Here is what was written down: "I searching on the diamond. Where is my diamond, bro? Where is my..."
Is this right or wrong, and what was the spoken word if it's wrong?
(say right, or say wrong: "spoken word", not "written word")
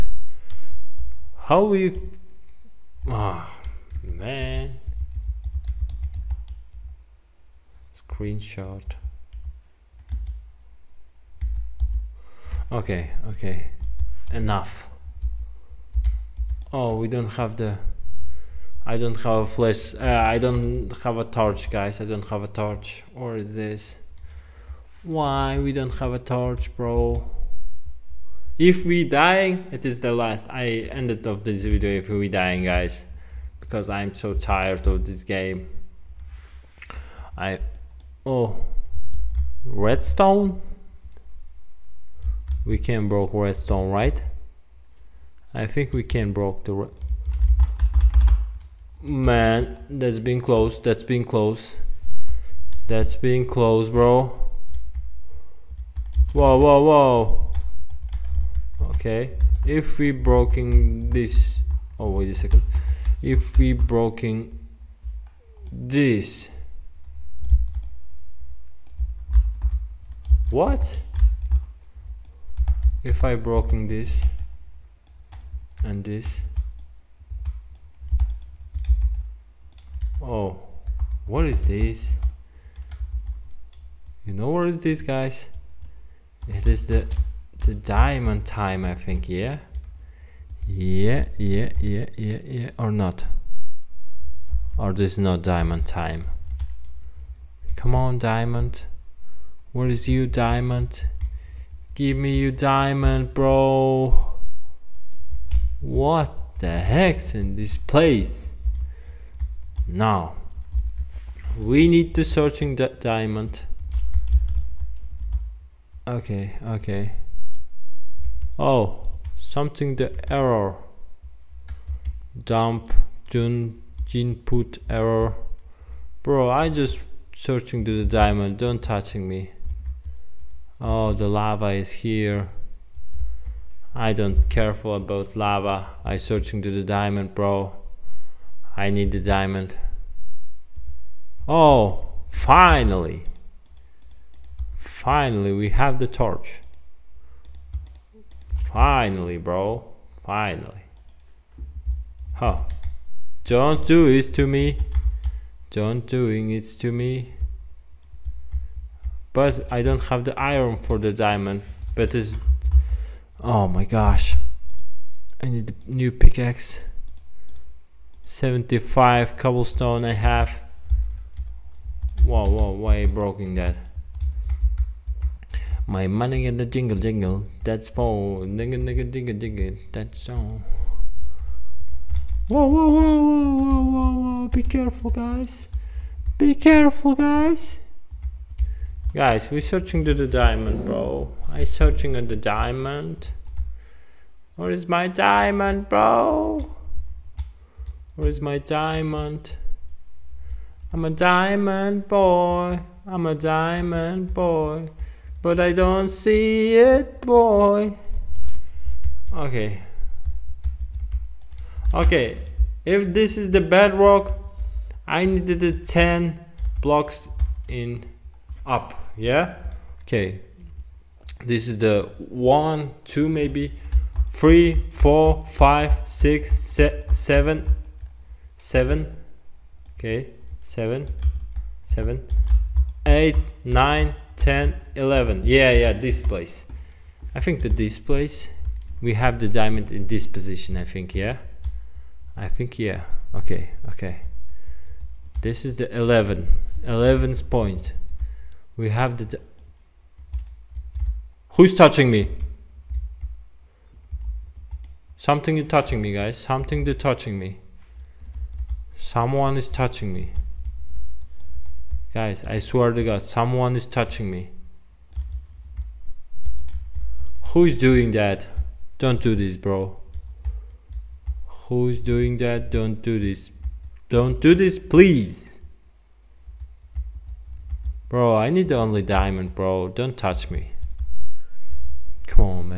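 right.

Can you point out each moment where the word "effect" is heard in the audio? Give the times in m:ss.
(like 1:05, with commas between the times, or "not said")
not said.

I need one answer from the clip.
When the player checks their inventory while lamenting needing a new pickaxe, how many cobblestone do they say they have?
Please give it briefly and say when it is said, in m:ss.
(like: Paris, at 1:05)
75, at 2:48.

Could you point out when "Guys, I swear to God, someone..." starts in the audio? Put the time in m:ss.
4:22.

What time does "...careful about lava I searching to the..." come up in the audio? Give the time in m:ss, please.
2:14.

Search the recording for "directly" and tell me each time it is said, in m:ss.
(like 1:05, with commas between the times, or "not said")
not said.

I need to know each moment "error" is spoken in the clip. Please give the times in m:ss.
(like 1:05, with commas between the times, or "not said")
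2:00, 2:04.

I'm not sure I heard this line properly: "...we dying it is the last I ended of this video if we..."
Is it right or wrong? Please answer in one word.
right.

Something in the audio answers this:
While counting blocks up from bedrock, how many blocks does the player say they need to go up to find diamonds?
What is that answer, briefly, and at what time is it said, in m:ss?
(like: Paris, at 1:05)
10, at 3:35.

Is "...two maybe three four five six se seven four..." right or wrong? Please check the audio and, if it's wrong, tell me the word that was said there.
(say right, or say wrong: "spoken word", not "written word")
wrong: "seven", not "four".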